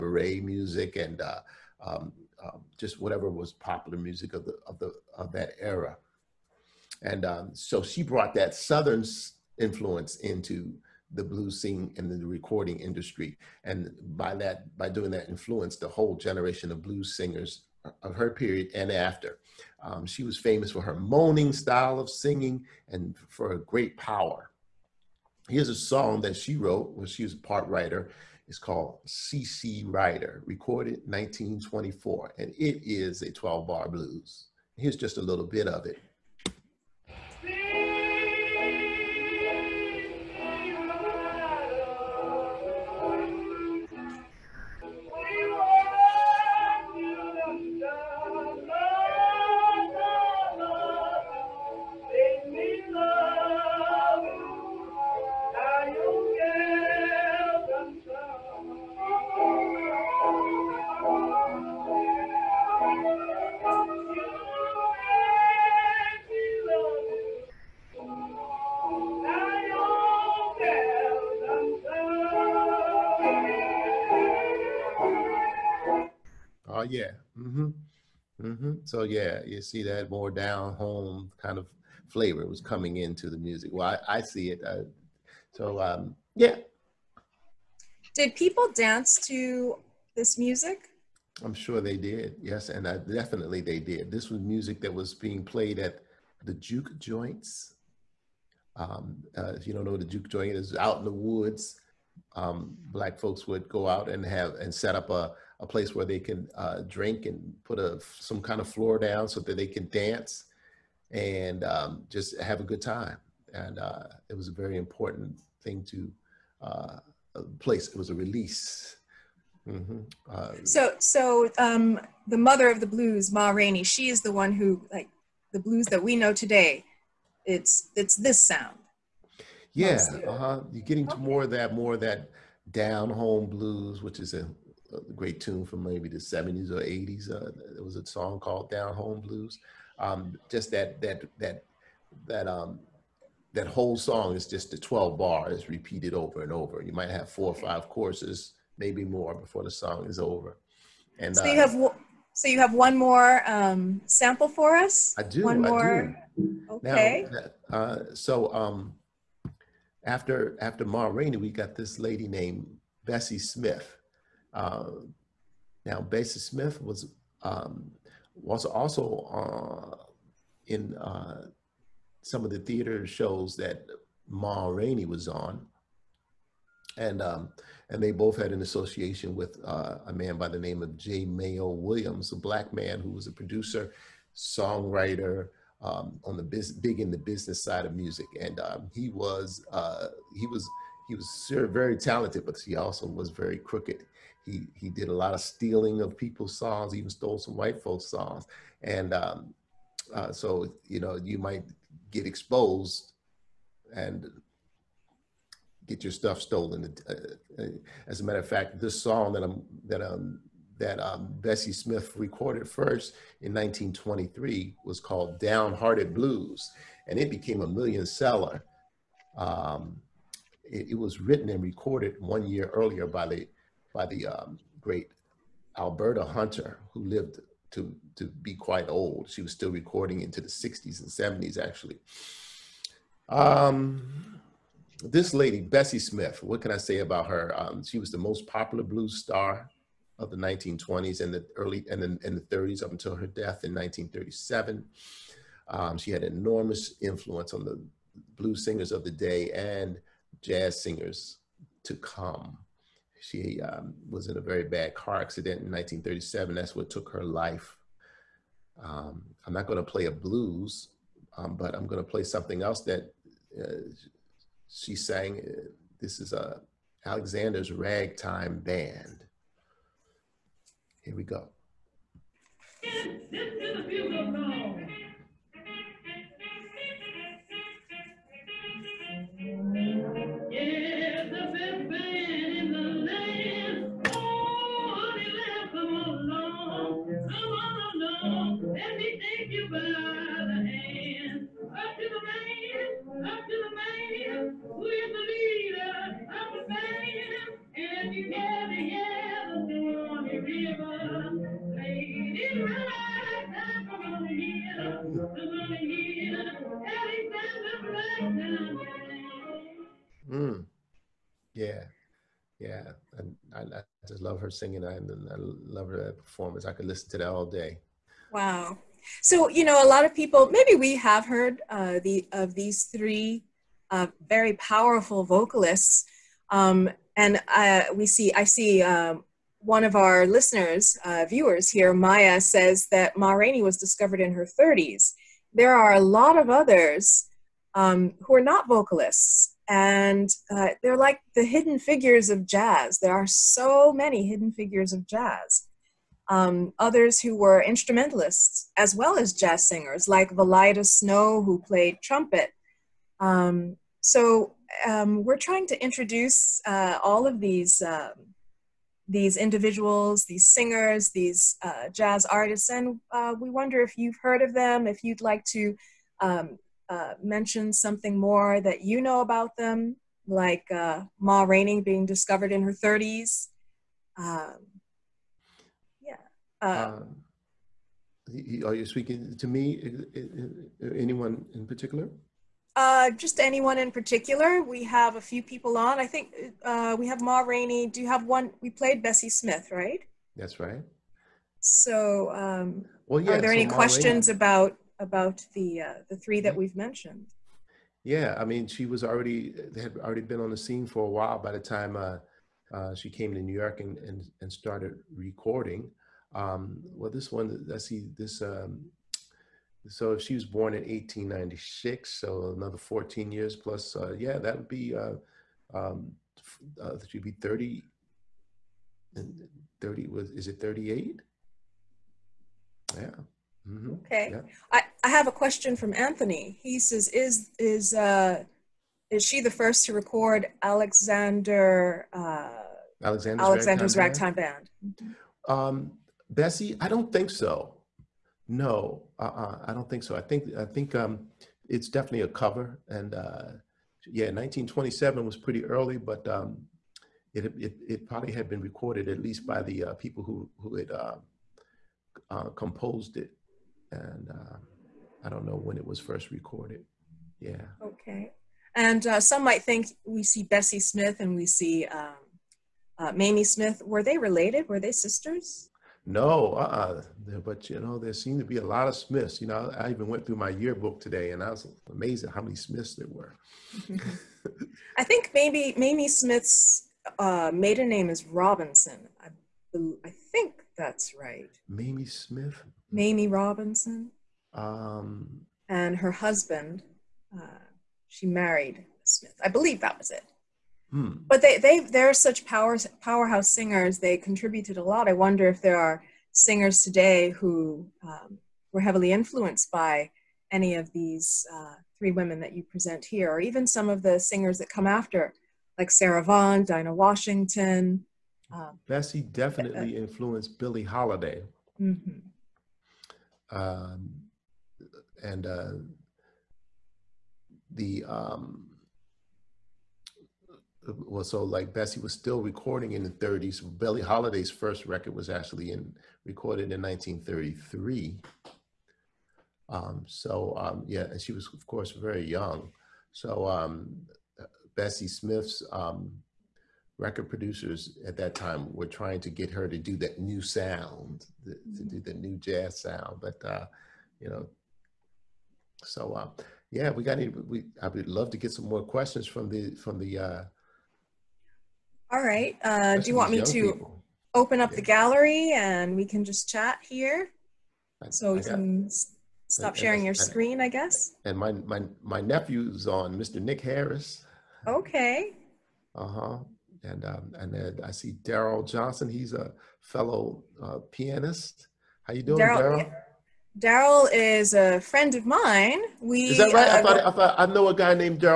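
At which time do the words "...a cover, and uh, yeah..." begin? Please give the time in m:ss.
7:22.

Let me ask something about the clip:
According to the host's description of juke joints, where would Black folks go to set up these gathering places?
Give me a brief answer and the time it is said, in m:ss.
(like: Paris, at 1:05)
out in the woods, at 1:40.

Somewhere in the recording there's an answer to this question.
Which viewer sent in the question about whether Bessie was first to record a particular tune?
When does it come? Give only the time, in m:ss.
7:05.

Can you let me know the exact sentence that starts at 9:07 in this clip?
Any, we I would love to get some more questions from the from the.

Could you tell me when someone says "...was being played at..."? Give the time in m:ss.
1:34.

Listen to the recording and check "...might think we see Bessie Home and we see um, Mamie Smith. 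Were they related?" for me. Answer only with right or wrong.
wrong.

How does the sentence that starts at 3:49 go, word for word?
She was still recording into the 60s and 70s, actually.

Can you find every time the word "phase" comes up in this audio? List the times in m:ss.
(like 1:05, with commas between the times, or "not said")
not said.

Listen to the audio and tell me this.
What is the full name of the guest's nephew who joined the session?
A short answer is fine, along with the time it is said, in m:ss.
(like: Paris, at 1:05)
Nick Harris, at 9:23.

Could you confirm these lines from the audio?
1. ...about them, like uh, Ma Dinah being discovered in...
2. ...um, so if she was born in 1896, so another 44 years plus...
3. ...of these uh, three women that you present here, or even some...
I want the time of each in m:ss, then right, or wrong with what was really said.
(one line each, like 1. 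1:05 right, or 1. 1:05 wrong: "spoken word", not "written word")
1. 6:09 wrong: "Rainey", not "Dinah"
2. 6:48 wrong: "14", not "44"
3. 8:20 right.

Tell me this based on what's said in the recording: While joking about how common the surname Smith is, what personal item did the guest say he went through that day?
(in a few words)
yearbook.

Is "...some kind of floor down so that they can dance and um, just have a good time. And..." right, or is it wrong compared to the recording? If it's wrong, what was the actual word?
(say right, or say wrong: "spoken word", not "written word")
right.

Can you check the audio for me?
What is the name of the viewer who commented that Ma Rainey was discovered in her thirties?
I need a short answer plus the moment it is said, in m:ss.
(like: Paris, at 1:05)
Maya, at 5:31.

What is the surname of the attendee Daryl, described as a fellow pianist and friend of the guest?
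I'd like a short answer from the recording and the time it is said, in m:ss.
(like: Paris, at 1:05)
Johnson, at 9:28.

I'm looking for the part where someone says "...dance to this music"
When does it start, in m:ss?
1:28.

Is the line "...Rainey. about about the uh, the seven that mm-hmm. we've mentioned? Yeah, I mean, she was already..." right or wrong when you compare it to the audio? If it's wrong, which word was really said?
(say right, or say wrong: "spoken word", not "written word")
wrong: "three", not "seven".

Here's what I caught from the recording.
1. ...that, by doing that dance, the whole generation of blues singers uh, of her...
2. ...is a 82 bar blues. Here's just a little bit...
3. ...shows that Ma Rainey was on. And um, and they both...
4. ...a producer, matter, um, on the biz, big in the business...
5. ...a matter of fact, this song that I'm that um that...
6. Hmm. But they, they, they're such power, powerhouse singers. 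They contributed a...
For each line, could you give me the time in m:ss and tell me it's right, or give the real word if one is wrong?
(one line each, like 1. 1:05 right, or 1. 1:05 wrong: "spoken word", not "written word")
1. 0:14 wrong: "influence", not "dance"
2. 0:32 wrong: "12", not "82"
3. 2:53 right
4. 3:03 wrong: "songwriter", not "matter"
5. 3:28 right
6. 8:10 right.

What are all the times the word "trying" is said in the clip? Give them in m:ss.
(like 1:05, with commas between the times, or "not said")
5:55, 8:58.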